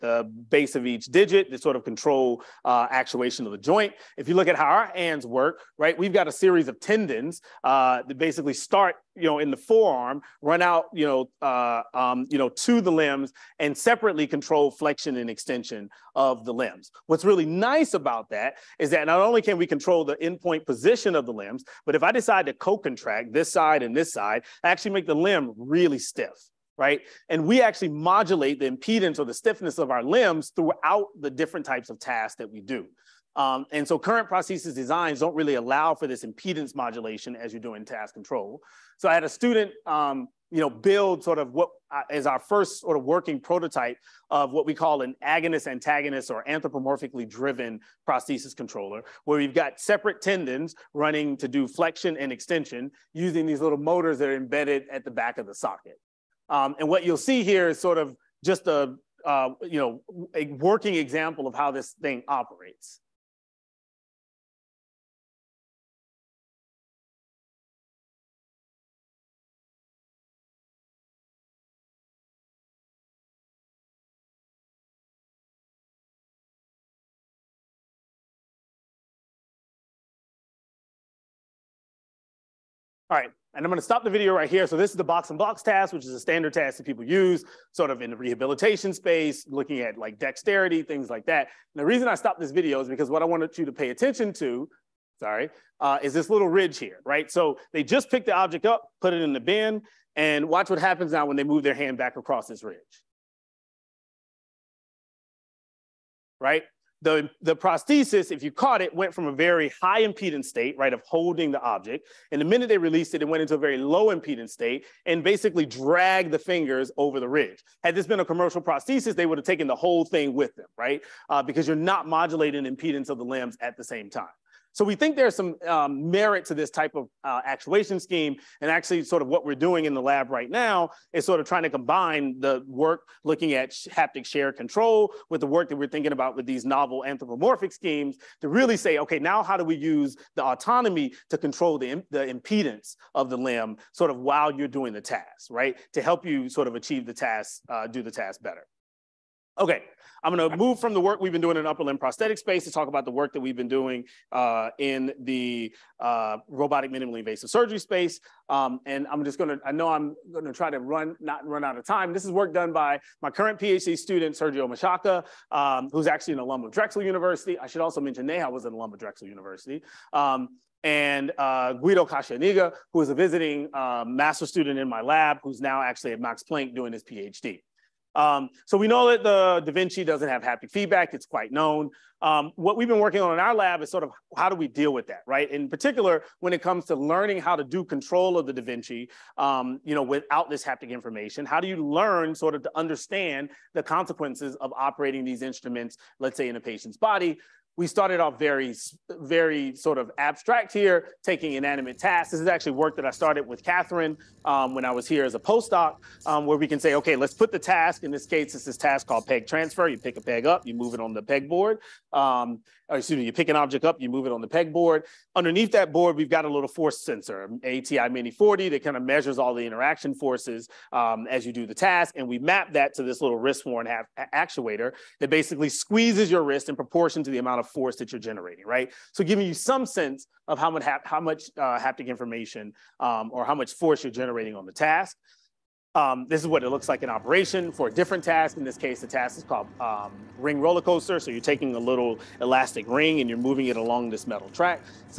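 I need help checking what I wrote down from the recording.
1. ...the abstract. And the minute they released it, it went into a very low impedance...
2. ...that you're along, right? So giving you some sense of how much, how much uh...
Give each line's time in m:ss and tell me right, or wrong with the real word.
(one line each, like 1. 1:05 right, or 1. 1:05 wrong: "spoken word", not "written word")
1. 1:51 wrong: "object", not "abstract"
2. 3:47 wrong: "generating", not "along".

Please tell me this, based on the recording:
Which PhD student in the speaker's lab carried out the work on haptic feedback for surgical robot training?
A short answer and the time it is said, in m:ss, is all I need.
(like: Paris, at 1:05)
Sergio Machaca, at 2:44.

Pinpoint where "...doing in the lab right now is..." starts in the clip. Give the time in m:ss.
2:09.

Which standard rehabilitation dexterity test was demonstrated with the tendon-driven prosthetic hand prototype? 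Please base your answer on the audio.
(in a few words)
Box and blocks task.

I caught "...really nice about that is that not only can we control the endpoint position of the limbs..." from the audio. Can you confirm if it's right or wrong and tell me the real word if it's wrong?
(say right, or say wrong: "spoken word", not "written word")
right.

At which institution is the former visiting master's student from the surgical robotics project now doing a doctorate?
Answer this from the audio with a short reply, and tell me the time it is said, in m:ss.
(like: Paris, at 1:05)
Max Planck, at 2:56.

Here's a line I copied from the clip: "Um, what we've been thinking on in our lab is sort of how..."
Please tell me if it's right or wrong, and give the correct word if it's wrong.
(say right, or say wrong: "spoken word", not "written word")
wrong: "working", not "thinking".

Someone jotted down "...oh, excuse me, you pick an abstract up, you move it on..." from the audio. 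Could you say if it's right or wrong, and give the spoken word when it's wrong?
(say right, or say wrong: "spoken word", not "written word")
wrong: "object", not "abstract".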